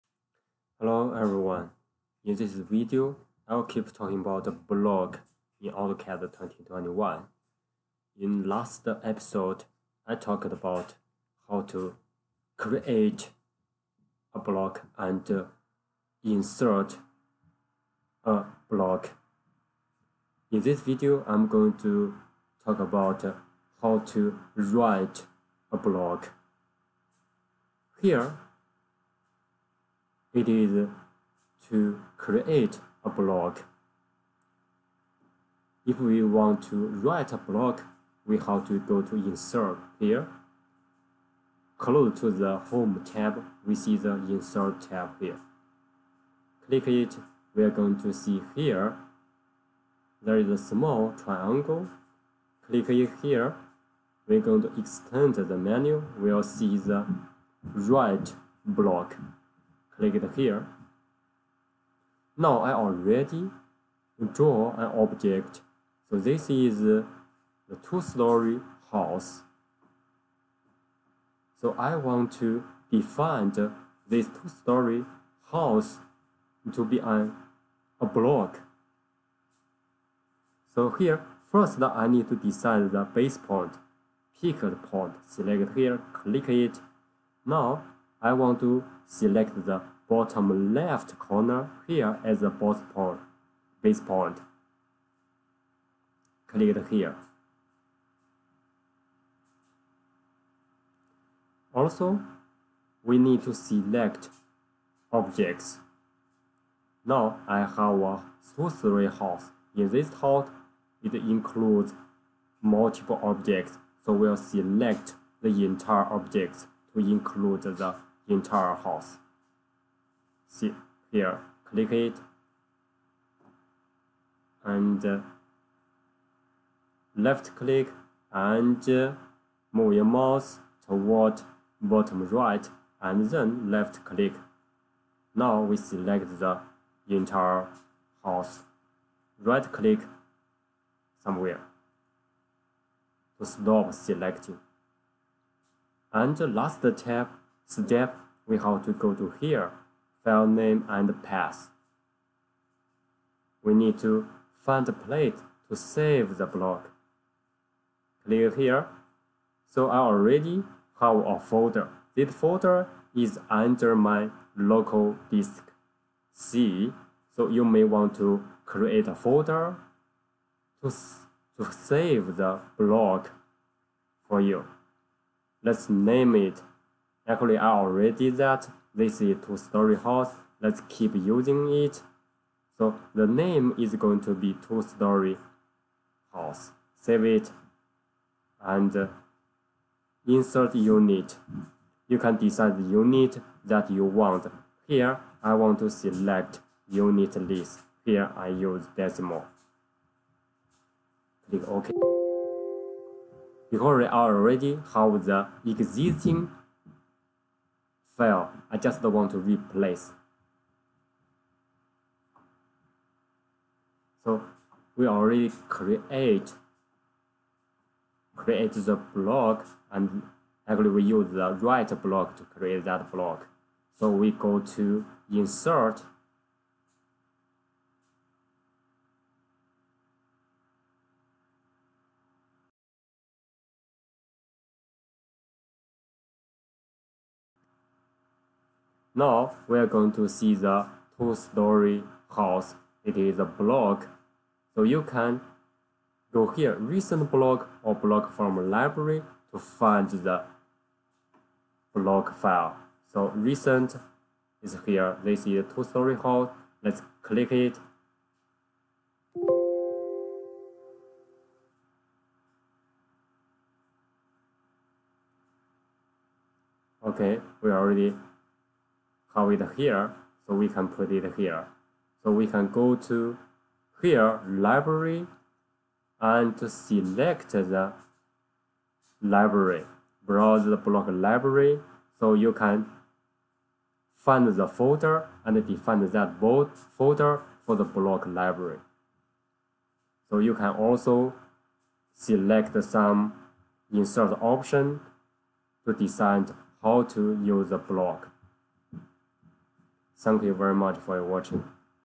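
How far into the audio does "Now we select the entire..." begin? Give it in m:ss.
2:15.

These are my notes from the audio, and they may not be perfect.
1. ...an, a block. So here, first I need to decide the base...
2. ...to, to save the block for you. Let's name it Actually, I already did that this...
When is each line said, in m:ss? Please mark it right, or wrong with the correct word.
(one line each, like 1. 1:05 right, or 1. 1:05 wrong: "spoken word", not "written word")
1. 1:16 right
2. 2:50 right.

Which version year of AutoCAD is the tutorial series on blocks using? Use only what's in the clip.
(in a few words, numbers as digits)
2021.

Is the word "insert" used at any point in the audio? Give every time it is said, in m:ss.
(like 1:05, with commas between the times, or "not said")
0:16, 0:39, 0:44, 3:10, 3:45, 4:53.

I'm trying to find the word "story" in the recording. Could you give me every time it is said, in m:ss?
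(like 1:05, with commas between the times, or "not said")
1:07, 1:14, 2:59, 3:04, 4:01, 4:15.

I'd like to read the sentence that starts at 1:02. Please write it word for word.
Now I already draw an object.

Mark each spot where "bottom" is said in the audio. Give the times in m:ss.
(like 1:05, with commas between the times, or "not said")
1:30, 2:11.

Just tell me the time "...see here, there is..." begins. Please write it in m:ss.
0:48.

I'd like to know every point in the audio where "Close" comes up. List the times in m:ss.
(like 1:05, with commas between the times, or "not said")
0:41.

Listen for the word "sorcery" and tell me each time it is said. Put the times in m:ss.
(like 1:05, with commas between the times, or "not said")
1:48.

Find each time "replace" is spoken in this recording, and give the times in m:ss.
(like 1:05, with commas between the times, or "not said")
3:29.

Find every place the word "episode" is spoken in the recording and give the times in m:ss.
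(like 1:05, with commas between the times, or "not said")
0:08.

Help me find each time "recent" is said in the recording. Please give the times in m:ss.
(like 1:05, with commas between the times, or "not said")
4:06, 4:13.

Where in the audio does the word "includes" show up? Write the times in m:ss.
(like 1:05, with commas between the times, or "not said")
1:51, 1:56.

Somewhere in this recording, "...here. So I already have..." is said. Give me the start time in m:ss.
2:38.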